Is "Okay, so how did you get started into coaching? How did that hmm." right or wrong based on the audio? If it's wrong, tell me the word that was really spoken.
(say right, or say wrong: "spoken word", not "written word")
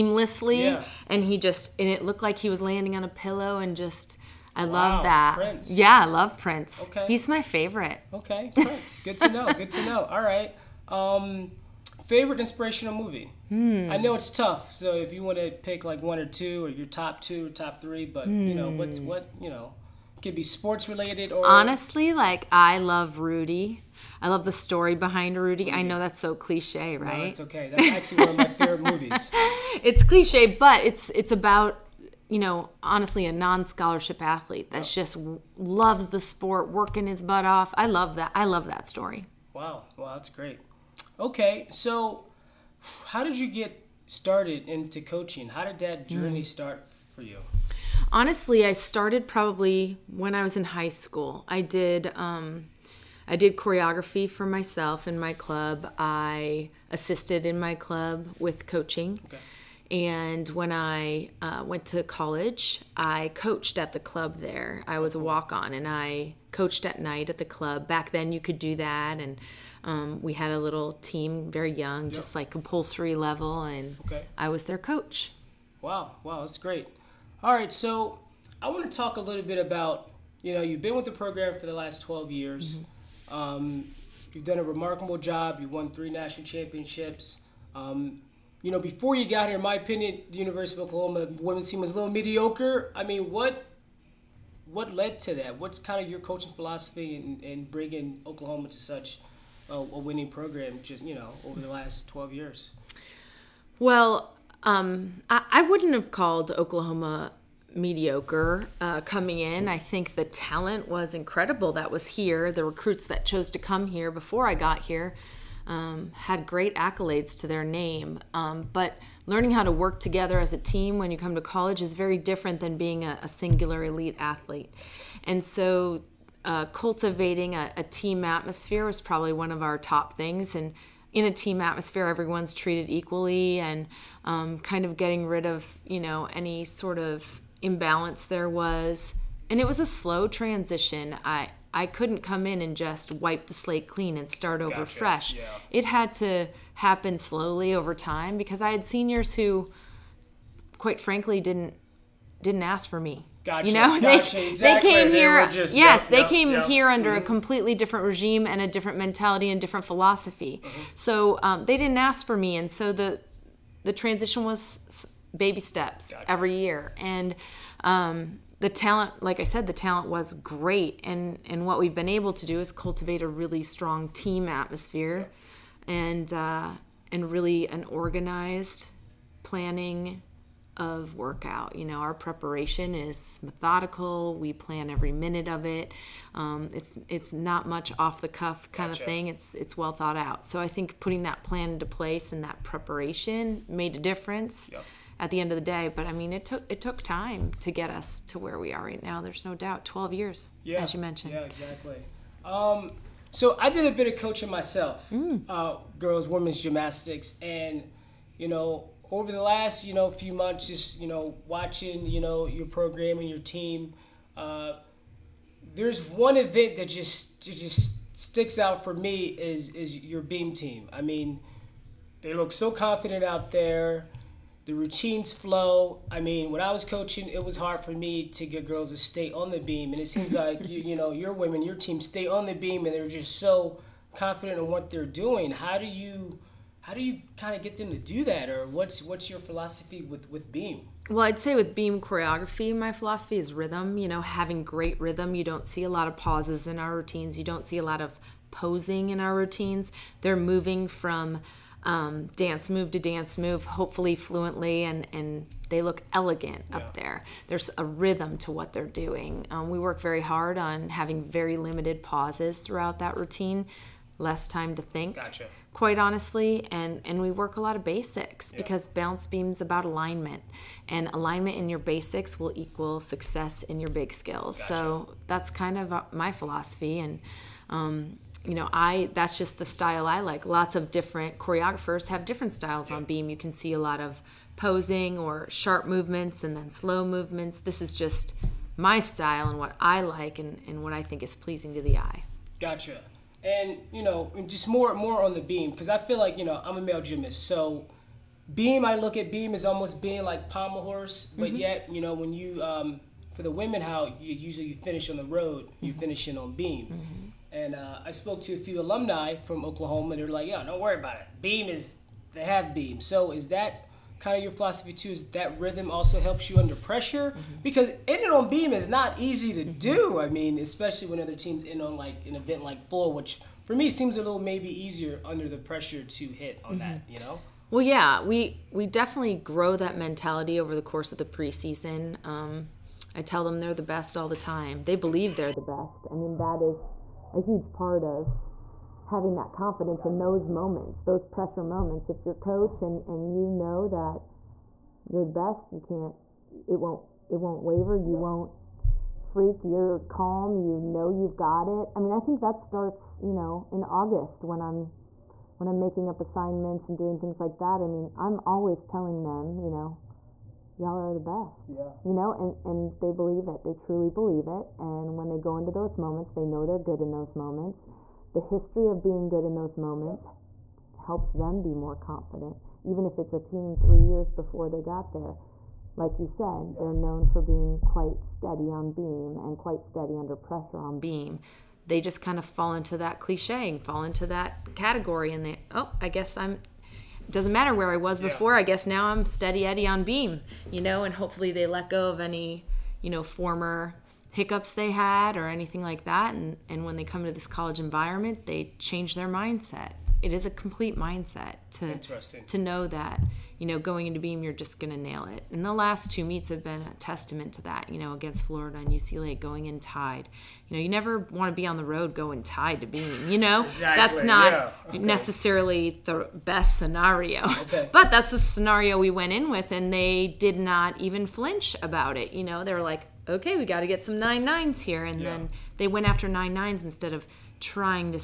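right.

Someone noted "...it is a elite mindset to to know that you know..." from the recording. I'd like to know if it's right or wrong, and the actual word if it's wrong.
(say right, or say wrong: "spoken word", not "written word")
wrong: "complete", not "elite".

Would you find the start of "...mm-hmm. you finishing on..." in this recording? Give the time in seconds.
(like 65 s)
305 s.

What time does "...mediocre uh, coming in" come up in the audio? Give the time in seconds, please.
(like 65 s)
107 s.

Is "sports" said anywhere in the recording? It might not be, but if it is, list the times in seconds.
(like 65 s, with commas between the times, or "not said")
20 s, 36 s.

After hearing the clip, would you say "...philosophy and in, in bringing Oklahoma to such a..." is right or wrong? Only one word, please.
right.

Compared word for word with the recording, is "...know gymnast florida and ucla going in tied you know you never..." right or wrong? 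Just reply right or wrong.
wrong.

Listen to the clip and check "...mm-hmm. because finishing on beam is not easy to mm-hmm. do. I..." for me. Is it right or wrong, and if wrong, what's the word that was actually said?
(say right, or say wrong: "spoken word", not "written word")
wrong: "ending", not "finishing".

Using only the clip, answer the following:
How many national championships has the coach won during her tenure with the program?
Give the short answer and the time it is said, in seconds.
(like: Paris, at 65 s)
3, at 85 s.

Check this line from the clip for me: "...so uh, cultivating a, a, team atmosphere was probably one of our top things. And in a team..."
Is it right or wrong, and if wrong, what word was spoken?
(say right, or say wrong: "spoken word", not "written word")
right.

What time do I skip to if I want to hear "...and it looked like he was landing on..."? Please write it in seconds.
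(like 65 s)
1 s.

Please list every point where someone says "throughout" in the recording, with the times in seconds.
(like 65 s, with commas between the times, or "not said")
262 s.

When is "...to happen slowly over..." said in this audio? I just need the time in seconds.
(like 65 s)
146 s.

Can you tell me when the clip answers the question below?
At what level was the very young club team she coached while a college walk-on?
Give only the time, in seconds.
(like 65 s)
72 s.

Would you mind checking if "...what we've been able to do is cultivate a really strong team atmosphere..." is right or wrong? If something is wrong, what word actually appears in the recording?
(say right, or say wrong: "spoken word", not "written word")
right.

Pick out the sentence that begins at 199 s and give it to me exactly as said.
There's no doubt, 12 years, yeah, as you mentioned.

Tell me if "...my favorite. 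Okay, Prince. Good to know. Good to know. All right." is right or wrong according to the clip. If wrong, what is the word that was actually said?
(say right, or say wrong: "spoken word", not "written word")
right.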